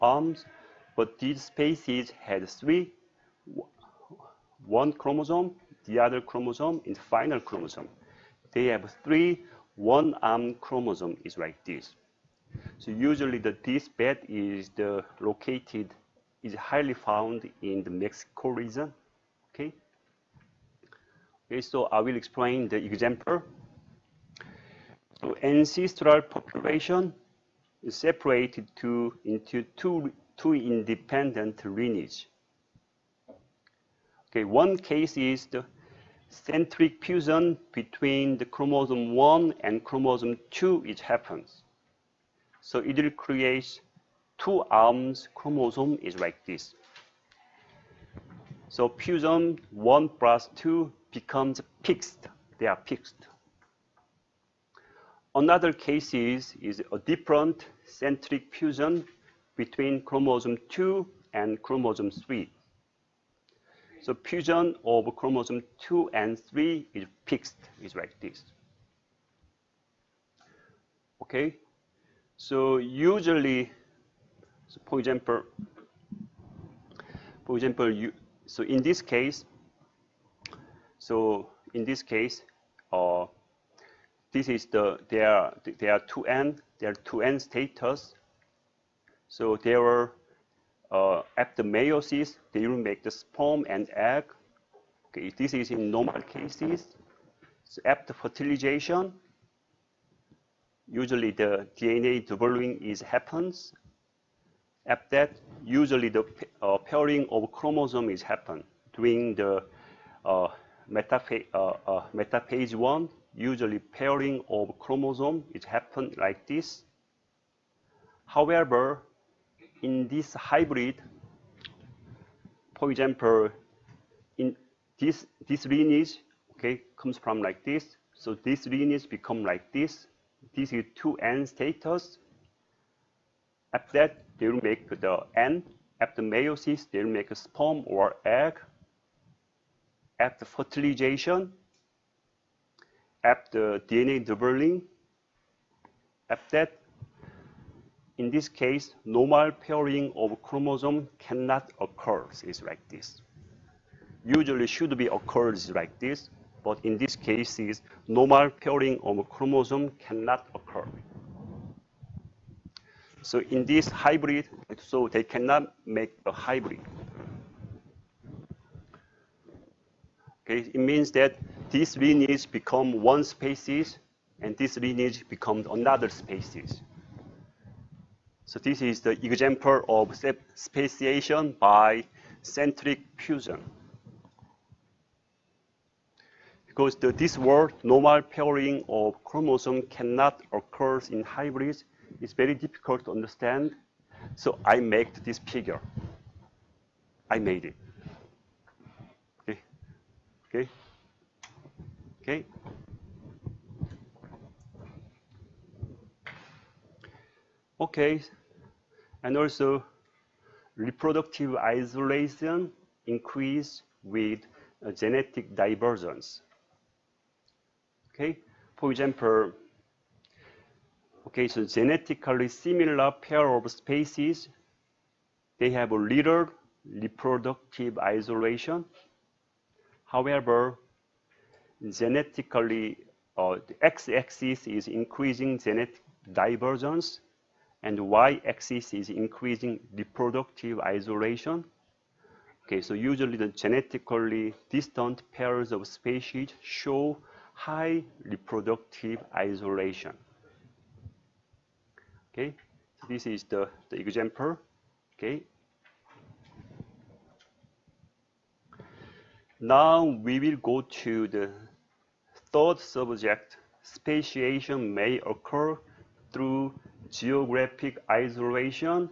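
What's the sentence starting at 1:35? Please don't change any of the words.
Okay, this is in normal cases.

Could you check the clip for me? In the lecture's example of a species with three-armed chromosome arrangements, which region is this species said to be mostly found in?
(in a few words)
Mexico.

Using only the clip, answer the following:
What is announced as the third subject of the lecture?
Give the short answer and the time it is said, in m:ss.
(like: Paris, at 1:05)
Geographic isolation, at 4:27.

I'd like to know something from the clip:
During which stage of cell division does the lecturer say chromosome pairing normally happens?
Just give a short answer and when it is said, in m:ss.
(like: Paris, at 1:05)
Metaphase one, at 1:52.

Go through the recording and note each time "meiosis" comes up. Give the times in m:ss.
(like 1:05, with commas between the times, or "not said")
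1:31, 2:16.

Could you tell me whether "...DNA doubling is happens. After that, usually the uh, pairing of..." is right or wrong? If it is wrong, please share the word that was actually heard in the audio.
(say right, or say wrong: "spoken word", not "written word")
right.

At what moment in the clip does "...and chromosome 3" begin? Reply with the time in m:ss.
1:01.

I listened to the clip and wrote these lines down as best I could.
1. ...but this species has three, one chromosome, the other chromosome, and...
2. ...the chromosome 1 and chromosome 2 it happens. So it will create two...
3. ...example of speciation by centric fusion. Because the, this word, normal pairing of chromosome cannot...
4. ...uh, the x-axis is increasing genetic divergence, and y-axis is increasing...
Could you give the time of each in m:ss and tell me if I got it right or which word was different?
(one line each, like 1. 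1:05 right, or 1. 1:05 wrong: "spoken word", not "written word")
1. 0:00 right
2. 0:38 right
3. 2:59 right
4. 3:53 right.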